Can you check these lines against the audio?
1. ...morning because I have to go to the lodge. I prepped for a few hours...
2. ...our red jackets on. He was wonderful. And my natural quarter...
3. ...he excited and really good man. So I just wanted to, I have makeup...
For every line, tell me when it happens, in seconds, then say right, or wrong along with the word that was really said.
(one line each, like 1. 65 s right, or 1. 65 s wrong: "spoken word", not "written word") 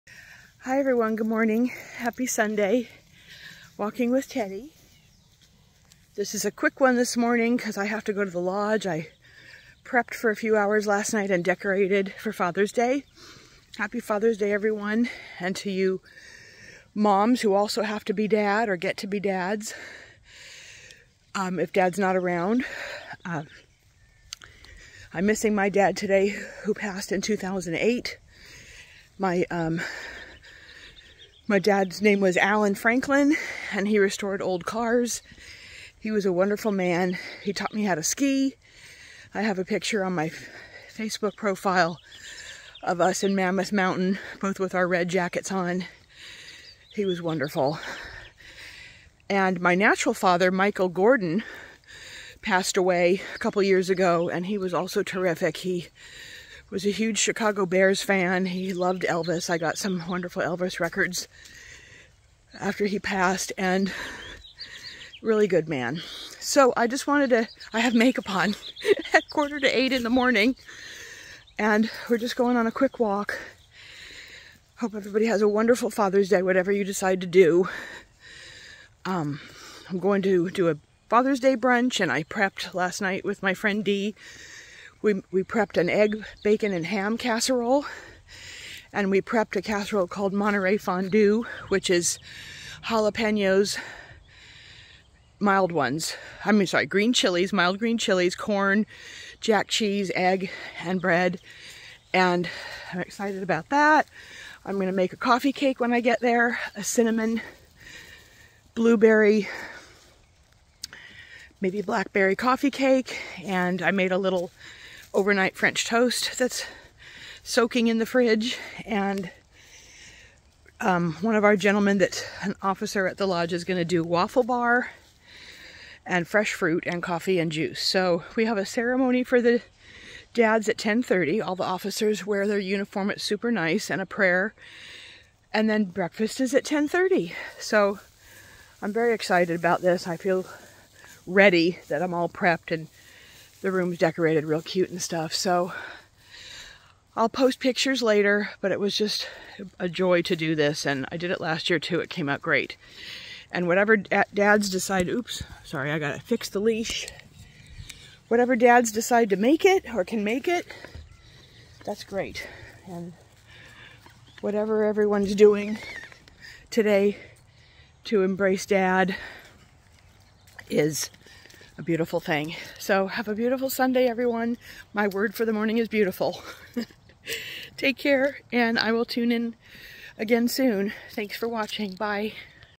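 1. 7 s right
2. 44 s wrong: "father", not "quarter"
3. 62 s wrong: "passed", not "excited".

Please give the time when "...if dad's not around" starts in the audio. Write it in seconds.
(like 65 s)
21 s.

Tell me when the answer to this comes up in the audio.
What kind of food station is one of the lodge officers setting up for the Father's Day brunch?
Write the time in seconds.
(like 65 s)
124 s.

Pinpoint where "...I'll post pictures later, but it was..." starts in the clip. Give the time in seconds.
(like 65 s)
147 s.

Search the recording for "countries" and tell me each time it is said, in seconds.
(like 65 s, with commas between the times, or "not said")
not said.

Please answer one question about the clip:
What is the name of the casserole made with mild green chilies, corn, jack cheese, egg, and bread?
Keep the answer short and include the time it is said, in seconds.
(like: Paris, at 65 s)
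Monterey Fondue, at 90 s.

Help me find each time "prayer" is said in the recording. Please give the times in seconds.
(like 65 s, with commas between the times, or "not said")
134 s.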